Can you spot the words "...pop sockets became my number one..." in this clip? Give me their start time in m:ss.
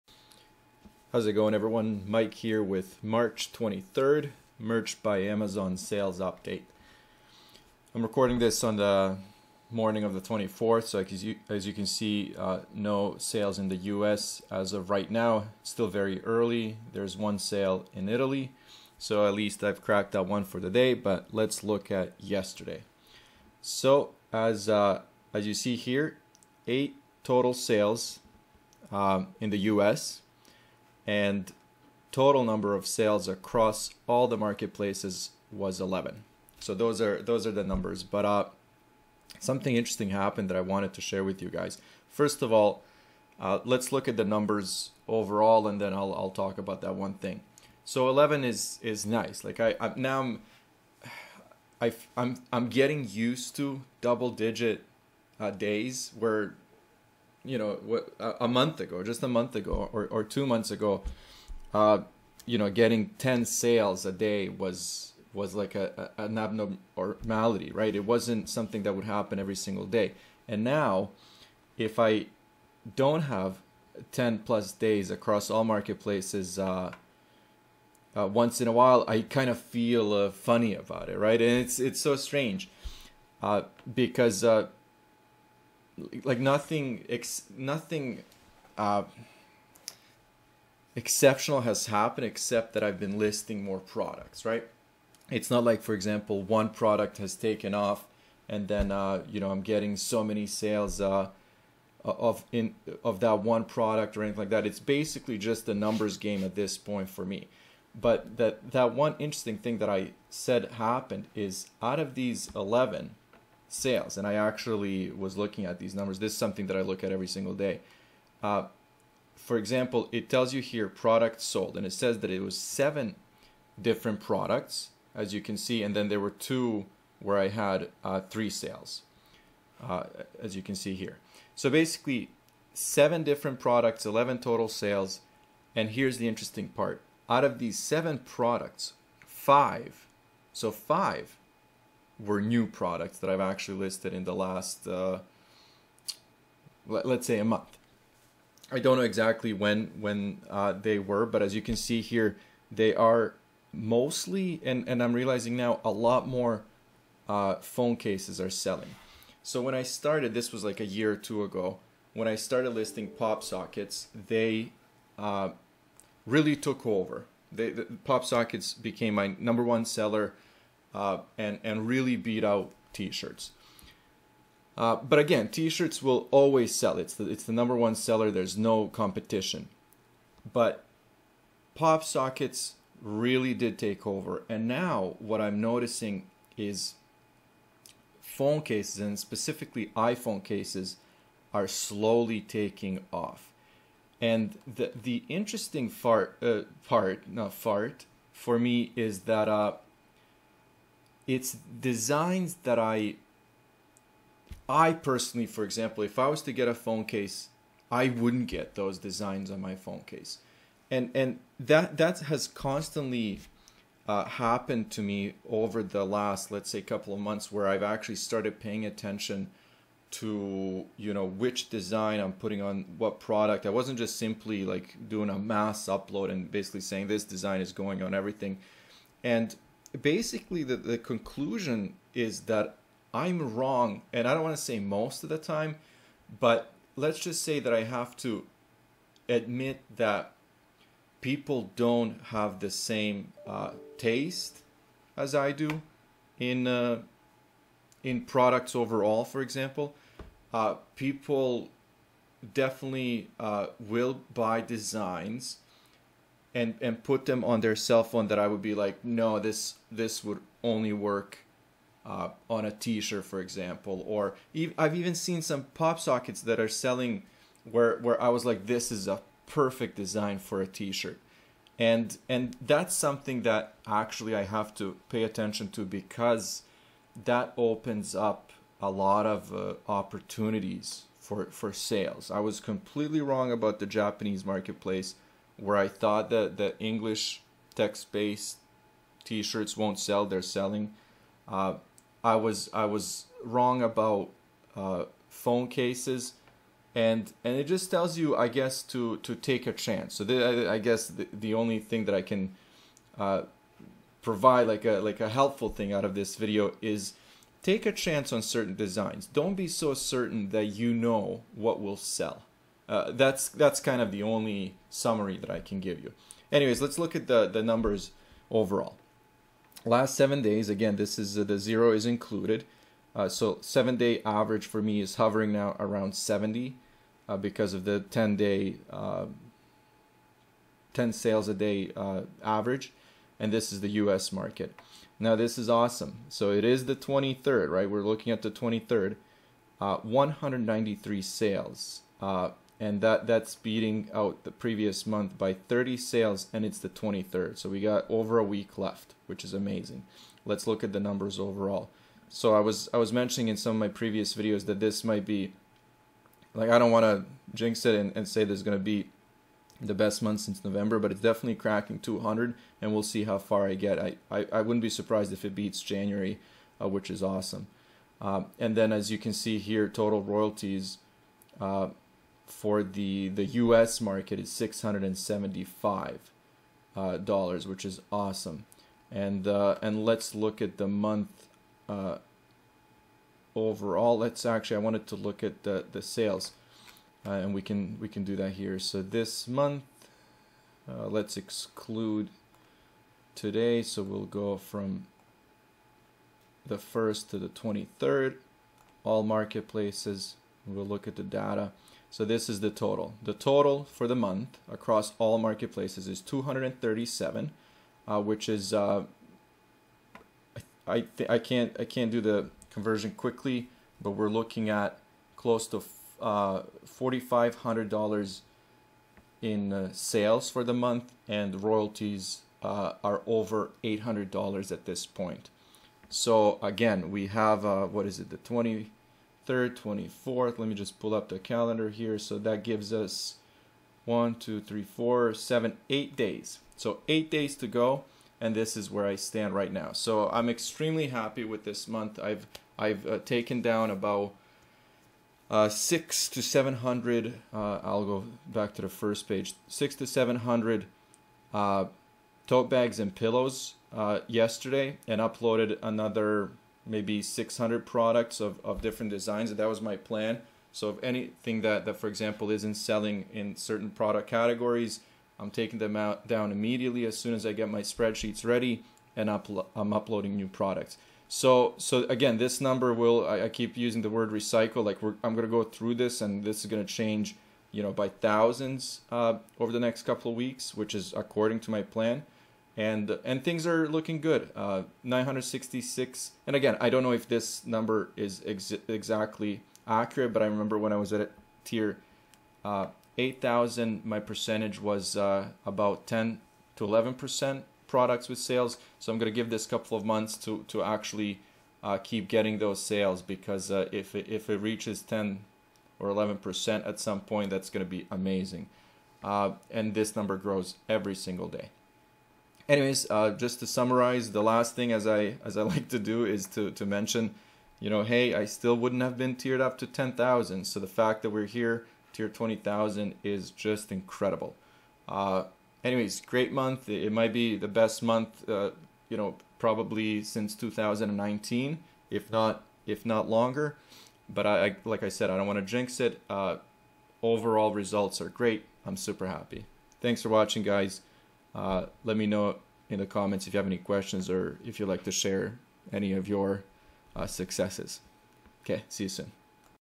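2:48.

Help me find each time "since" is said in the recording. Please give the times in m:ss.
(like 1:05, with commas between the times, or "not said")
6:00, 8:50.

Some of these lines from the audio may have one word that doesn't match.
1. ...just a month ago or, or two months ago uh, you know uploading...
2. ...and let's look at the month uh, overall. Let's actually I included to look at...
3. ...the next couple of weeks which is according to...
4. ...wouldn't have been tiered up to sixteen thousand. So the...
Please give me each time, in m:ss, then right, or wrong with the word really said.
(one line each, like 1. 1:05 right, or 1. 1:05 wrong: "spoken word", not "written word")
1. 0:59 wrong: "getting", not "uploading"
2. 6:19 wrong: "wanted", not "included"
3. 7:59 right
4. 8:38 wrong: "ten", not "sixteen".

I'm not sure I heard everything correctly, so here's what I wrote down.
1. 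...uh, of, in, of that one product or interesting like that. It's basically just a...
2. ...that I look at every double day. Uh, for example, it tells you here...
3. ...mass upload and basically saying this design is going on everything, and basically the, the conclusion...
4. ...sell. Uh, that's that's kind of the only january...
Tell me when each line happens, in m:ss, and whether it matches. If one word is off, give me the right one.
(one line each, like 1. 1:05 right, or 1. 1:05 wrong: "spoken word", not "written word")
1. 1:40 wrong: "anything", not "interesting"
2. 1:56 wrong: "single", not "double"
3. 3:45 right
4. 5:11 wrong: "summary", not "january".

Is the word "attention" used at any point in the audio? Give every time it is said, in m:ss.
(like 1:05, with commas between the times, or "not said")
3:38, 4:35.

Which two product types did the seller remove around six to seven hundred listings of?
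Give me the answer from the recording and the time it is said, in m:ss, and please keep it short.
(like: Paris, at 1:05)
Tote bags and pillows, at 7:32.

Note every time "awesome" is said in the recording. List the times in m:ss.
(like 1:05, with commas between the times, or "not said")
5:35, 6:07, 6:18.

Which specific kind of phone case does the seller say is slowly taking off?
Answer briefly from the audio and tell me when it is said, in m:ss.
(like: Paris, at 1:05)
iPhone cases, at 3:09.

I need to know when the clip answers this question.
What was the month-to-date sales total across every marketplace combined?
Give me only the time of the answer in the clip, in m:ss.
6:46.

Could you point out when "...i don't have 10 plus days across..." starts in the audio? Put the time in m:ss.
1:11.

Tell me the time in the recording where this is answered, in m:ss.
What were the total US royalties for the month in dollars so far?
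6:14.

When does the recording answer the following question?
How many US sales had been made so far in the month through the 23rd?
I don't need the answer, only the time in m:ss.
5:39.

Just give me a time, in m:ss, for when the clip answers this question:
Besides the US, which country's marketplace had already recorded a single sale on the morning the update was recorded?
0:18.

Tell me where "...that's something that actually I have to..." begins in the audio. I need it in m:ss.
4:32.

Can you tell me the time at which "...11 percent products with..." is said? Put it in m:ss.
8:16.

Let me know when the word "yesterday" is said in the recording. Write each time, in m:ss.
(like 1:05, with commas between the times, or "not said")
0:22, 7:34.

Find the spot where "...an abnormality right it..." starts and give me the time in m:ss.
1:06.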